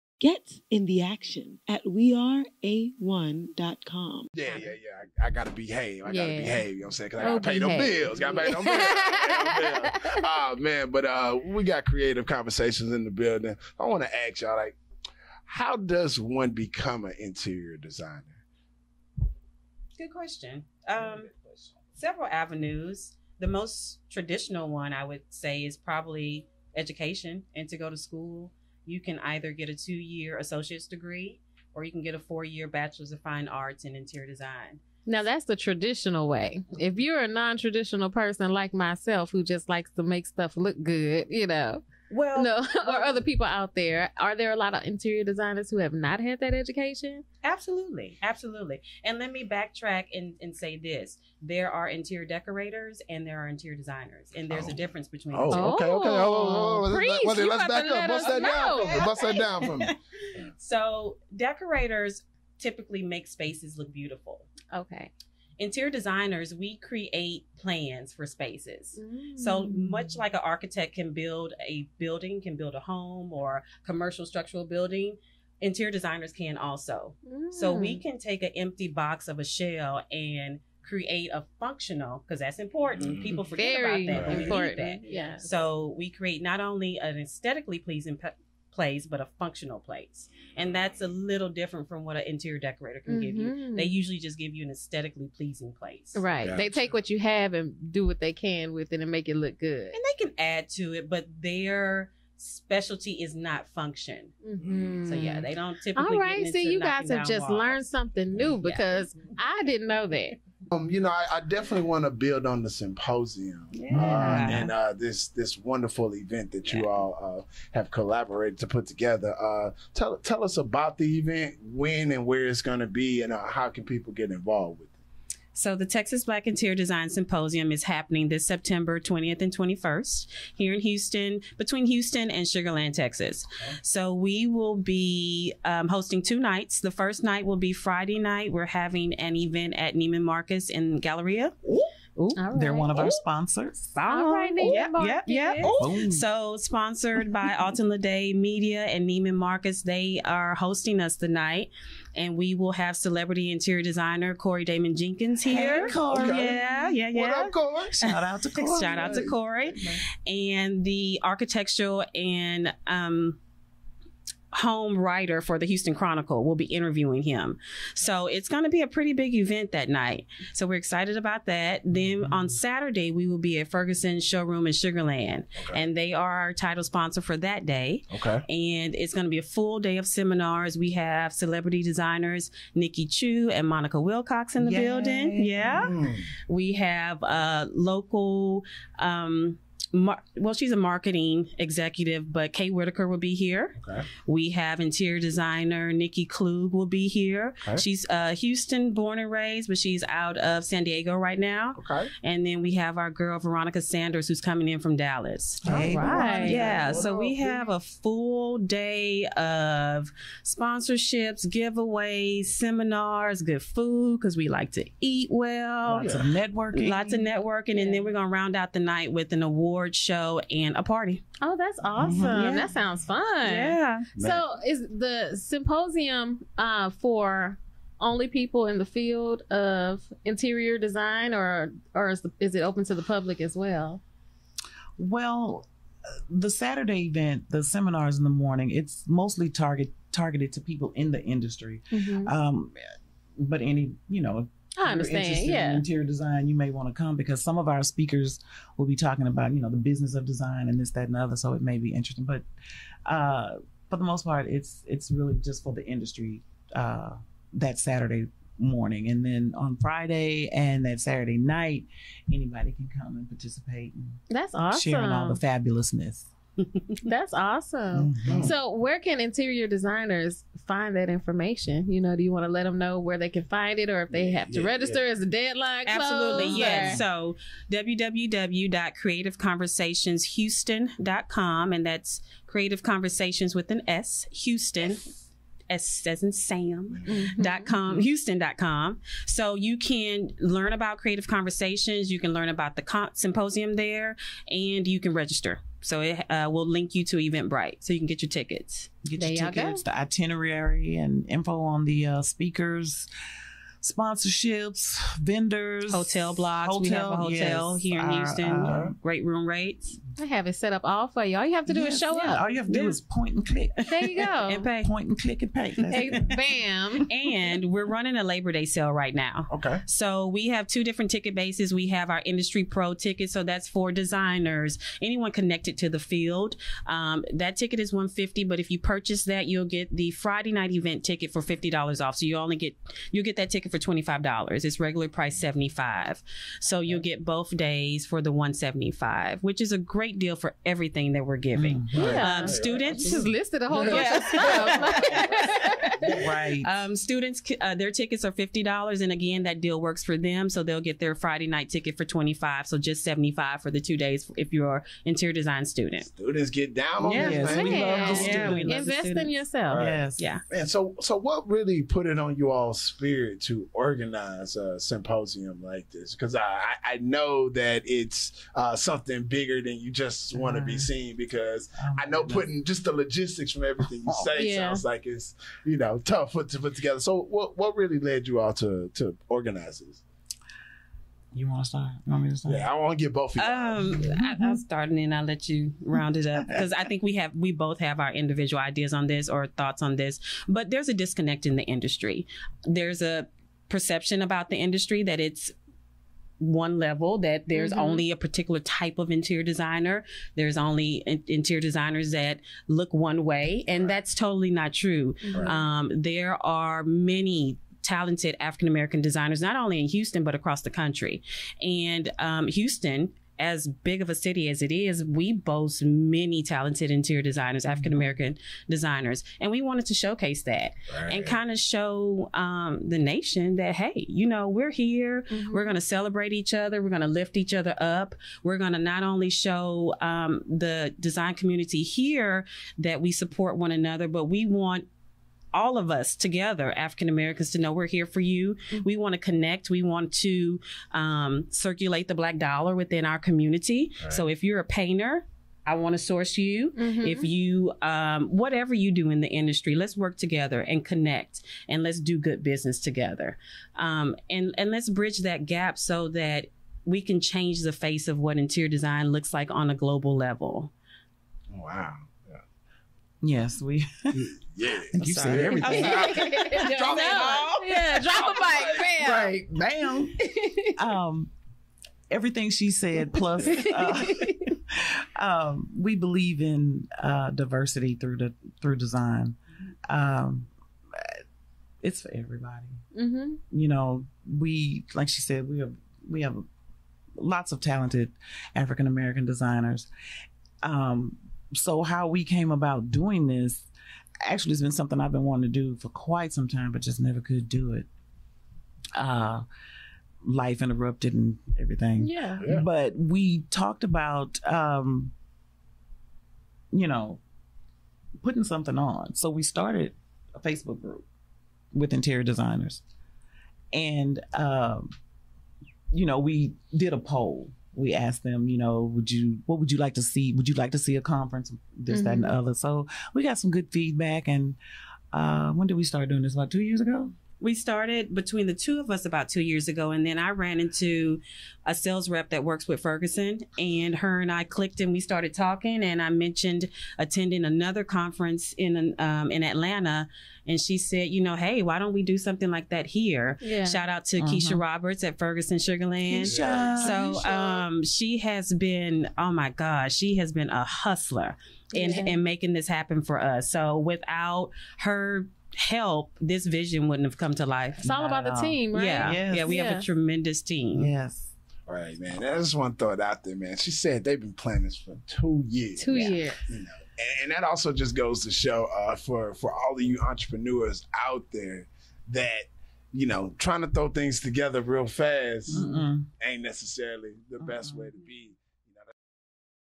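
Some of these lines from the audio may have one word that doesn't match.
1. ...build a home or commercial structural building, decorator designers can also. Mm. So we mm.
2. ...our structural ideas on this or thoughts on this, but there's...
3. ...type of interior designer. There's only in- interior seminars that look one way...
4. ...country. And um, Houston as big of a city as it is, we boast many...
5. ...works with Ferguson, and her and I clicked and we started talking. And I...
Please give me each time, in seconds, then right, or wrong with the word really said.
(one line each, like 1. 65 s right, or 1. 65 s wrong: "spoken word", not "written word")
1. 72 s wrong: "interior", not "decorator"
2. 388 s wrong: "individual", not "structural"
3. 398 s wrong: "designers", not "seminars"
4. 410 s right
5. 532 s right.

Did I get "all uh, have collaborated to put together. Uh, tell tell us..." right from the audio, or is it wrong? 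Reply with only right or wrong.
right.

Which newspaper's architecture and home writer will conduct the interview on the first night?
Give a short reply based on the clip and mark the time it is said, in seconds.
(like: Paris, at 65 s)
Houston Chronicle, at 165 s.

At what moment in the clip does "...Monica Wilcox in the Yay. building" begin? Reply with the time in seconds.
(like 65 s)
183 s.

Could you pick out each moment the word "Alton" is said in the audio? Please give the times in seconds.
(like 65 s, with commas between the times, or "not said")
147 s.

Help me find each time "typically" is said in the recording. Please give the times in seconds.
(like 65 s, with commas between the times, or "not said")
62 s, 105 s.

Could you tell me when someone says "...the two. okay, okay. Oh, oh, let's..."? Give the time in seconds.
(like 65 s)
55 s.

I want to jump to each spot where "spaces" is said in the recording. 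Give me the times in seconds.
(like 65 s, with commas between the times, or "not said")
63 s, 68 s.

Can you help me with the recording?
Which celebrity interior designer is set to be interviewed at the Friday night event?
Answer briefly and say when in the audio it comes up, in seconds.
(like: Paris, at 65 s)
Corey Damon Jenkins, at 154 s.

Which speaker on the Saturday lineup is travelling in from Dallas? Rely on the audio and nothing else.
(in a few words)
Veronica Sanders.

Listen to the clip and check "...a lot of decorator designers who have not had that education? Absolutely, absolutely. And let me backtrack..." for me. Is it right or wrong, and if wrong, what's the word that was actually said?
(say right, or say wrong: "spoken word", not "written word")
wrong: "interior", not "decorator".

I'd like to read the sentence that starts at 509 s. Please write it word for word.
So we started a Facebook group with interior designers.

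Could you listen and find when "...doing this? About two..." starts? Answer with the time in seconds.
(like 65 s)
526 s.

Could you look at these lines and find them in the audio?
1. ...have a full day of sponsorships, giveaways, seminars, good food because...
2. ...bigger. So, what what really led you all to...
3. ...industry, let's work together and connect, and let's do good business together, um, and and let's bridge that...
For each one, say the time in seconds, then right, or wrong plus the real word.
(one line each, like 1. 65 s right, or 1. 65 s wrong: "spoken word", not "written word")
1. 207 s right
2. 376 s wrong: "together", not "bigger"
3. 449 s right.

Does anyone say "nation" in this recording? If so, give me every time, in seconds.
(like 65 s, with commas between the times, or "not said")
422 s.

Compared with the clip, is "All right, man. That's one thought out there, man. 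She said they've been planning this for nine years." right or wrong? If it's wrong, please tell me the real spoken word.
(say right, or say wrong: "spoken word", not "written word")
wrong: "two", not "nine".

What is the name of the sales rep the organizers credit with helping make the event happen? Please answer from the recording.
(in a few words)
Keisha Roberts.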